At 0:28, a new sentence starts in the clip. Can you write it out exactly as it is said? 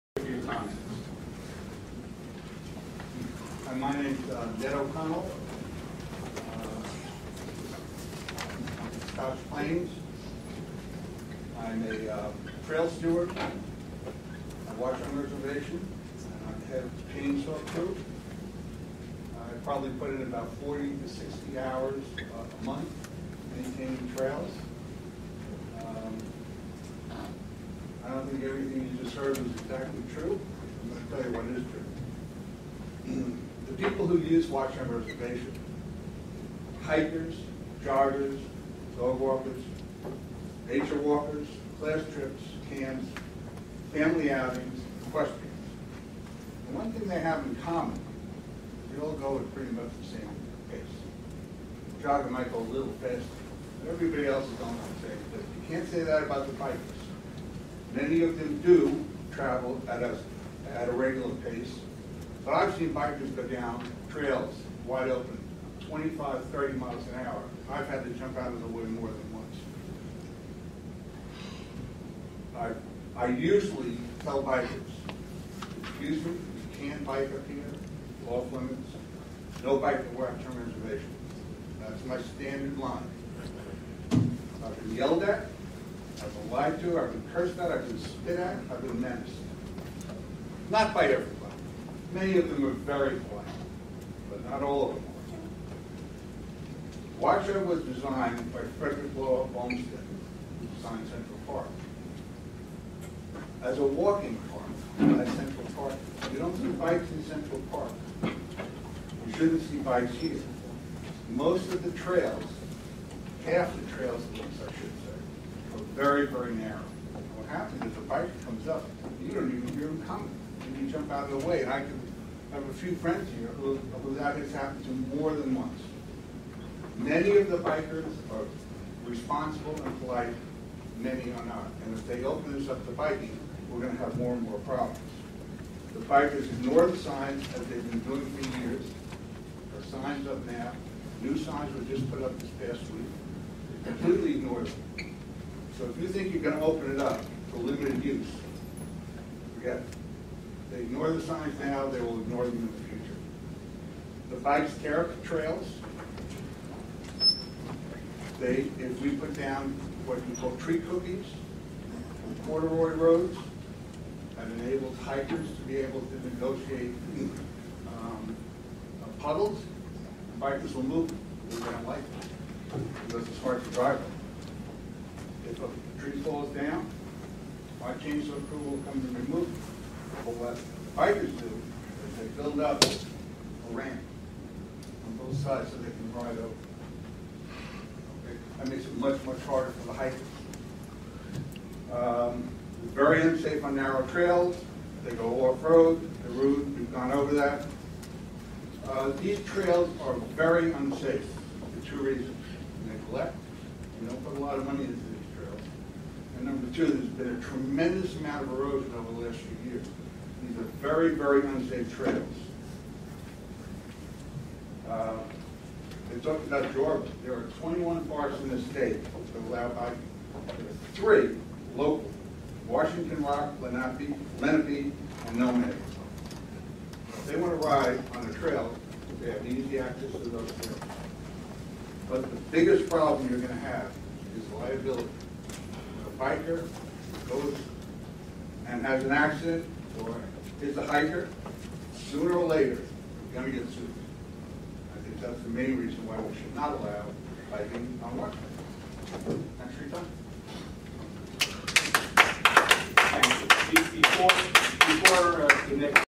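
everything you just heard was exactly true.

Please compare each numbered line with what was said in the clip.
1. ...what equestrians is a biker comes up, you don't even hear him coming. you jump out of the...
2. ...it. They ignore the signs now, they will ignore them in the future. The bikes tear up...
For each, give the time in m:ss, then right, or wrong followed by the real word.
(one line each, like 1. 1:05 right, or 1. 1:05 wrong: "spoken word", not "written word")
1. 1:57 wrong: "happens", not "equestrians"
2. 2:29 right.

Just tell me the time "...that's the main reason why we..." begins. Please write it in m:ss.
4:05.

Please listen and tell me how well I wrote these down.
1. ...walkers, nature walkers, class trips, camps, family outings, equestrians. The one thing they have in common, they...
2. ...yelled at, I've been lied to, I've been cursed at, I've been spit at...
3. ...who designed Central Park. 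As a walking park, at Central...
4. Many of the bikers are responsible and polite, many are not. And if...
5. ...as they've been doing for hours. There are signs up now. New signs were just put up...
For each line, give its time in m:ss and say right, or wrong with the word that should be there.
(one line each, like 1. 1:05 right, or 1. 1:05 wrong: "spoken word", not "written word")
1. 0:39 right
2. 1:24 right
3. 1:39 right
4. 2:06 right
5. 2:17 wrong: "years", not "hours".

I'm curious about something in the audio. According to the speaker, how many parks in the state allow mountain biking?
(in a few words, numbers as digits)
21.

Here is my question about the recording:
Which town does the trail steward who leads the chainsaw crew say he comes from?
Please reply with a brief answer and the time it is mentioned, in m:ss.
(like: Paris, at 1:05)
Scotch Plains, at 0:09.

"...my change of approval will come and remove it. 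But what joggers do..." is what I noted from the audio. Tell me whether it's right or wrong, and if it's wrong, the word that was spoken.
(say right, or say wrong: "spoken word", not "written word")
wrong: "bikers", not "joggers".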